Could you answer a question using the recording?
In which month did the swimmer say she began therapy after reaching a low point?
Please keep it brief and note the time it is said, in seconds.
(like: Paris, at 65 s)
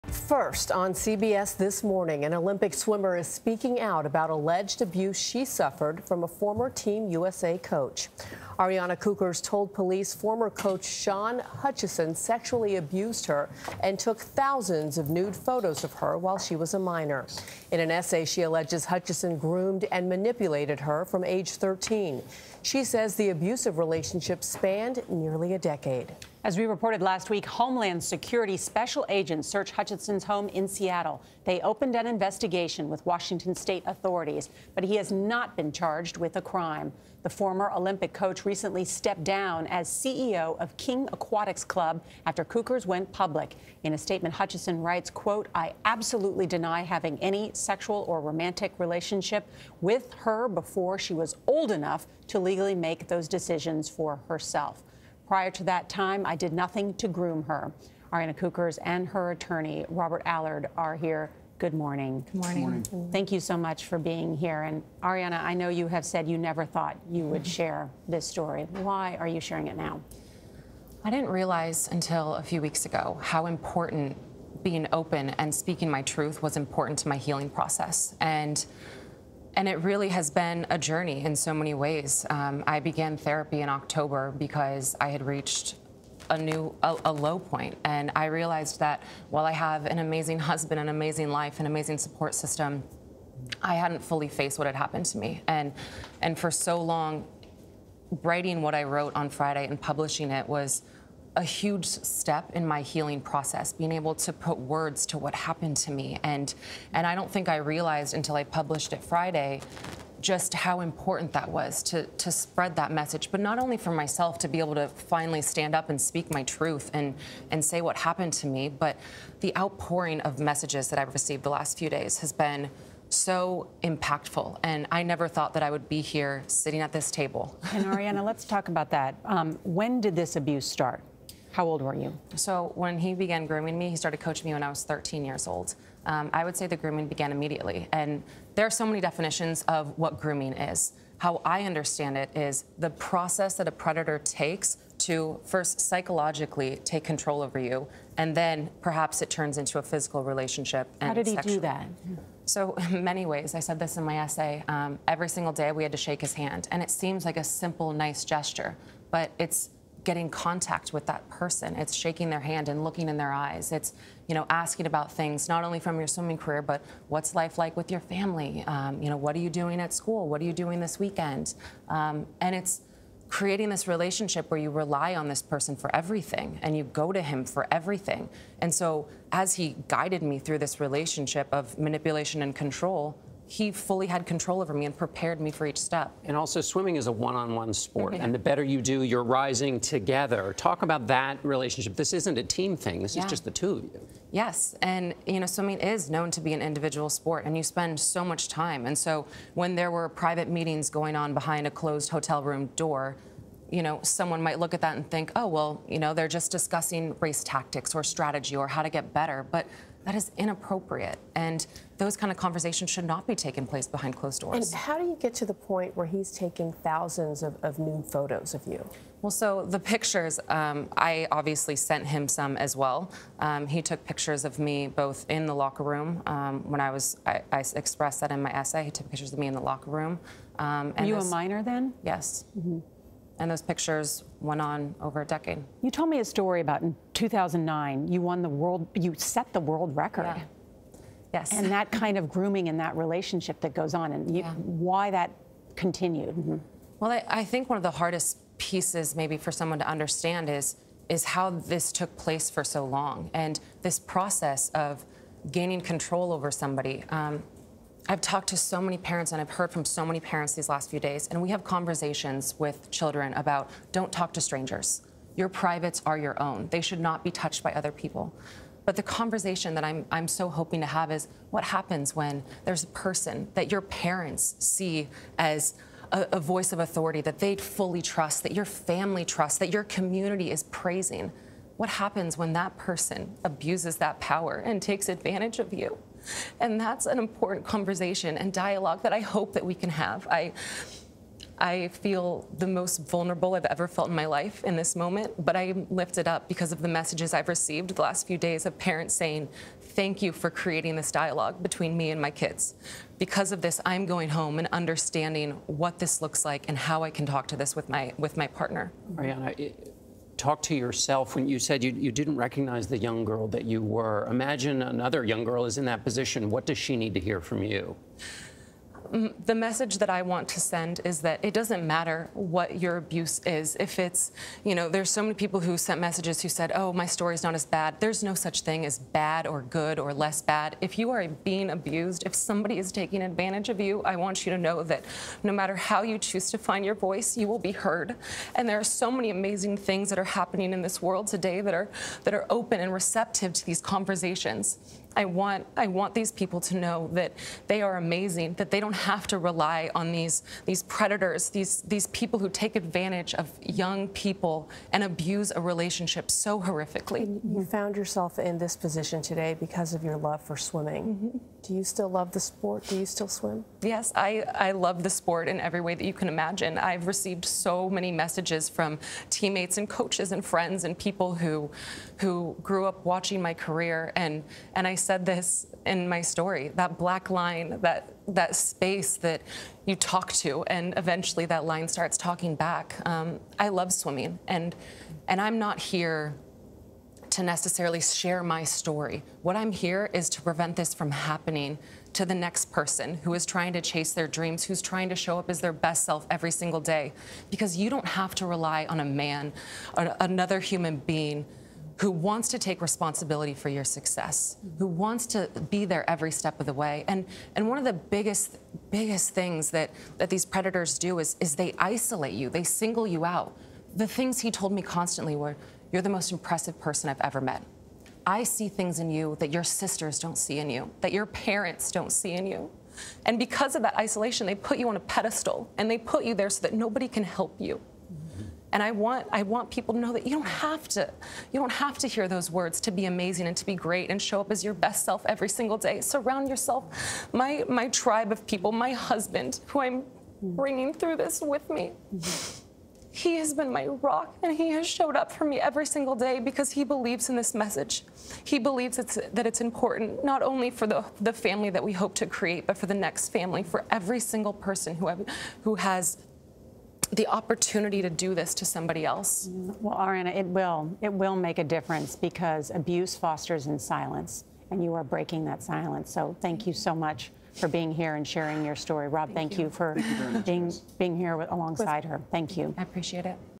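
October, at 83 s.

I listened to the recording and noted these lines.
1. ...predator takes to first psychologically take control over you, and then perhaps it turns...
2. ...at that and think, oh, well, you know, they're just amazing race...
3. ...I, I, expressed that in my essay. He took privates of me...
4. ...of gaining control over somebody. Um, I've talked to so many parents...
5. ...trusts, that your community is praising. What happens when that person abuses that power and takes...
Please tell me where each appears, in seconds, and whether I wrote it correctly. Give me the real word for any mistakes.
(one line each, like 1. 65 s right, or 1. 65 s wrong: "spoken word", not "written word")
1. 143 s right
2. 204 s wrong: "discussing", not "amazing"
3. 227 s wrong: "pictures", not "privates"
4. 254 s right
5. 279 s right.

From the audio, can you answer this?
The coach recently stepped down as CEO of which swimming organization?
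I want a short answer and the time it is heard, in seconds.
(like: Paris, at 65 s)
King Aquatics Club, at 40 s.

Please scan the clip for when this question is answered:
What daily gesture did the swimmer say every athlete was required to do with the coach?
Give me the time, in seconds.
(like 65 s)
155 s.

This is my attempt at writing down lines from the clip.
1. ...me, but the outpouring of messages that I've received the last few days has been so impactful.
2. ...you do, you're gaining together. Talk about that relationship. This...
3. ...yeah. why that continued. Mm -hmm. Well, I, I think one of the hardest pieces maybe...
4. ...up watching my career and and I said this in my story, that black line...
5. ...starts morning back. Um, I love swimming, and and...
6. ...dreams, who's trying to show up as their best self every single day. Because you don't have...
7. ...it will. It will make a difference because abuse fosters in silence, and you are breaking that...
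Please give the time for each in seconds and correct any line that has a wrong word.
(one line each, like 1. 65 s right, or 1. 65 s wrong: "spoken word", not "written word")
1. 118 s right
2. 188 s wrong: "rising", not "gaining"
3. 244 s right
4. 372 s right
5. 381 s wrong: "talking", not "morning"
6. 394 s right
7. 460 s right.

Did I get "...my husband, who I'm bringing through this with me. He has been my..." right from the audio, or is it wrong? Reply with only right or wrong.
right.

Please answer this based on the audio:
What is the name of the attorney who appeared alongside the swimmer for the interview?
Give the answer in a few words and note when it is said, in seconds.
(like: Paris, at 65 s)
Robert Allard, at 59 s.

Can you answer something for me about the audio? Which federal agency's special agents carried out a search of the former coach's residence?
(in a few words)
Homeland Security.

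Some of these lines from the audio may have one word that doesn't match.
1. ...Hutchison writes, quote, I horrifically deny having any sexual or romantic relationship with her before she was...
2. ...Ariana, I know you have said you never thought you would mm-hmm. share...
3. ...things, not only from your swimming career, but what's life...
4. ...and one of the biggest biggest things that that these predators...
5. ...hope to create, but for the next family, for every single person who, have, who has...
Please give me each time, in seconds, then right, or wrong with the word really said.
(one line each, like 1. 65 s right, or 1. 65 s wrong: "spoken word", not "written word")
1. 44 s wrong: "absolutely", not "horrifically"
2. 65 s right
3. 165 s right
4. 407 s right
5. 451 s right.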